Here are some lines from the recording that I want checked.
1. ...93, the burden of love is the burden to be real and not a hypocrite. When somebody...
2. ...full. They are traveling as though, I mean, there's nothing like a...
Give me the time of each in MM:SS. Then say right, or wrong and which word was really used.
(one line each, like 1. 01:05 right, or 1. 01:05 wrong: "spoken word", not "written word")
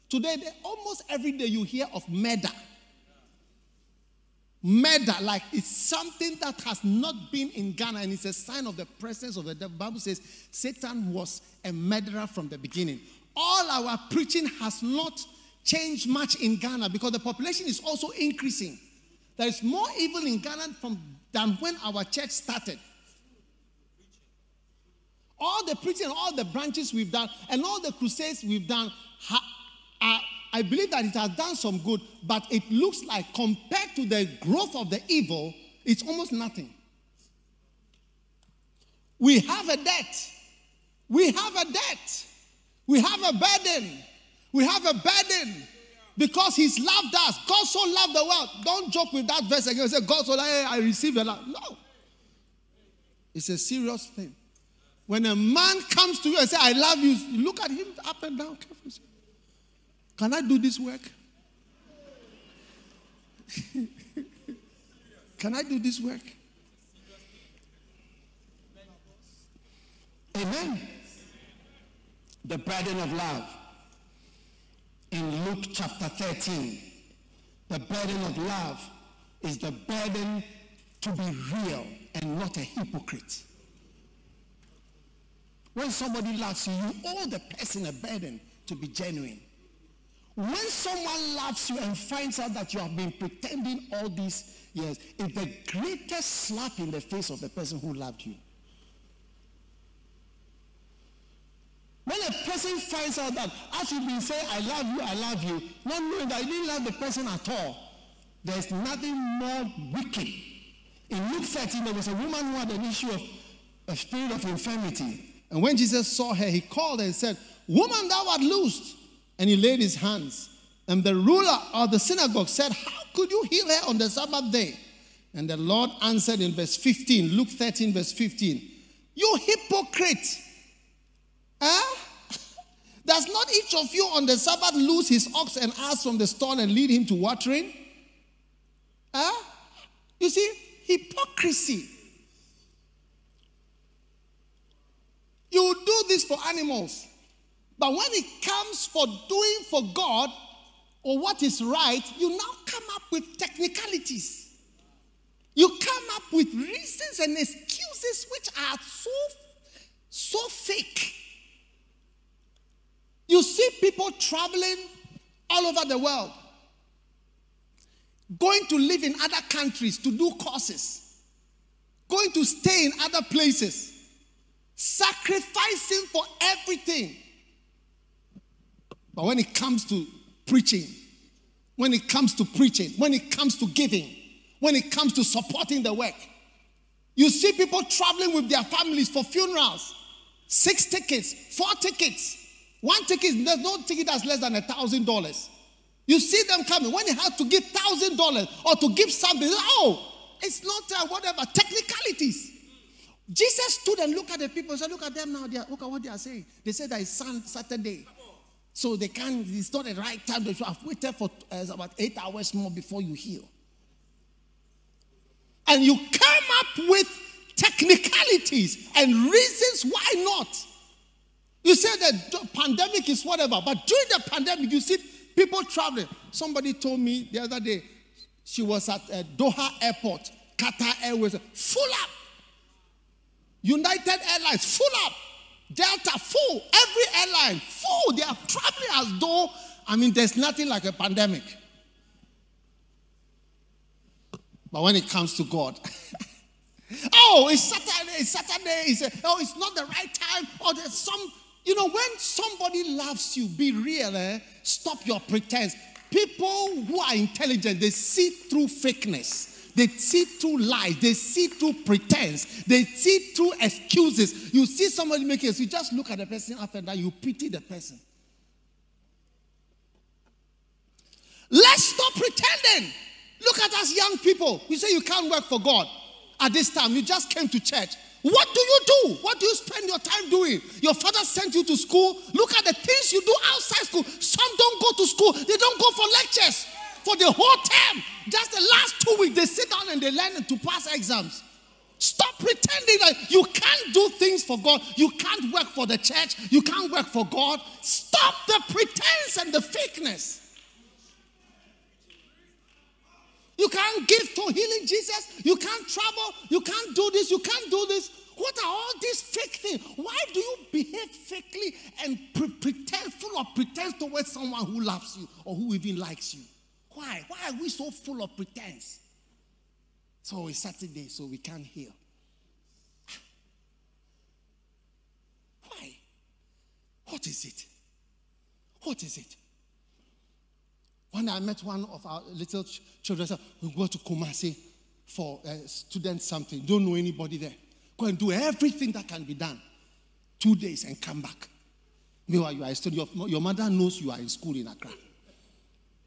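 1. 01:16 wrong: "13", not "93"
2. 03:57 right.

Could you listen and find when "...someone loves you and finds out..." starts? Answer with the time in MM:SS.
01:30.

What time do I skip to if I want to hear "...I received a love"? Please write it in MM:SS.
00:50.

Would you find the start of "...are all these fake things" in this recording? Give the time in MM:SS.
05:08.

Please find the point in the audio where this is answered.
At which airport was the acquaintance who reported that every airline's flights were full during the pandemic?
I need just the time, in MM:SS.
03:49.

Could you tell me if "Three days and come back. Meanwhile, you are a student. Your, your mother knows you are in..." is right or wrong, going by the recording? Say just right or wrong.
wrong.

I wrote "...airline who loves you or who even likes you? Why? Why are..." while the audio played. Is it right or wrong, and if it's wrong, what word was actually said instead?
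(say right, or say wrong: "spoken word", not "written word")
wrong: "someone", not "airline".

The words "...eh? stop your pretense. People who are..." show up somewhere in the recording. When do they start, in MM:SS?
04:14.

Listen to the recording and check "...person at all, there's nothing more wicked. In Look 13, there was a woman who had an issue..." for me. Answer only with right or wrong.
wrong.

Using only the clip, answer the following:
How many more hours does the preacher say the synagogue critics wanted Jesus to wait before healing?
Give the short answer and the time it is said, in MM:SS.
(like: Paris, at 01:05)
8, at 03:31.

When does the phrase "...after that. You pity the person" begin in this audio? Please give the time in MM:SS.
04:26.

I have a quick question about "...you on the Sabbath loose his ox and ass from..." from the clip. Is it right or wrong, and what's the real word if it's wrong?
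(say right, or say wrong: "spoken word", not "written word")
right.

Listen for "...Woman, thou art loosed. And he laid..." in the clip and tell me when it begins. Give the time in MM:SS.
01:57.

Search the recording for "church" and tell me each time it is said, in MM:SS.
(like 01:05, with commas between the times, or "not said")
00:22, 04:37, 04:55.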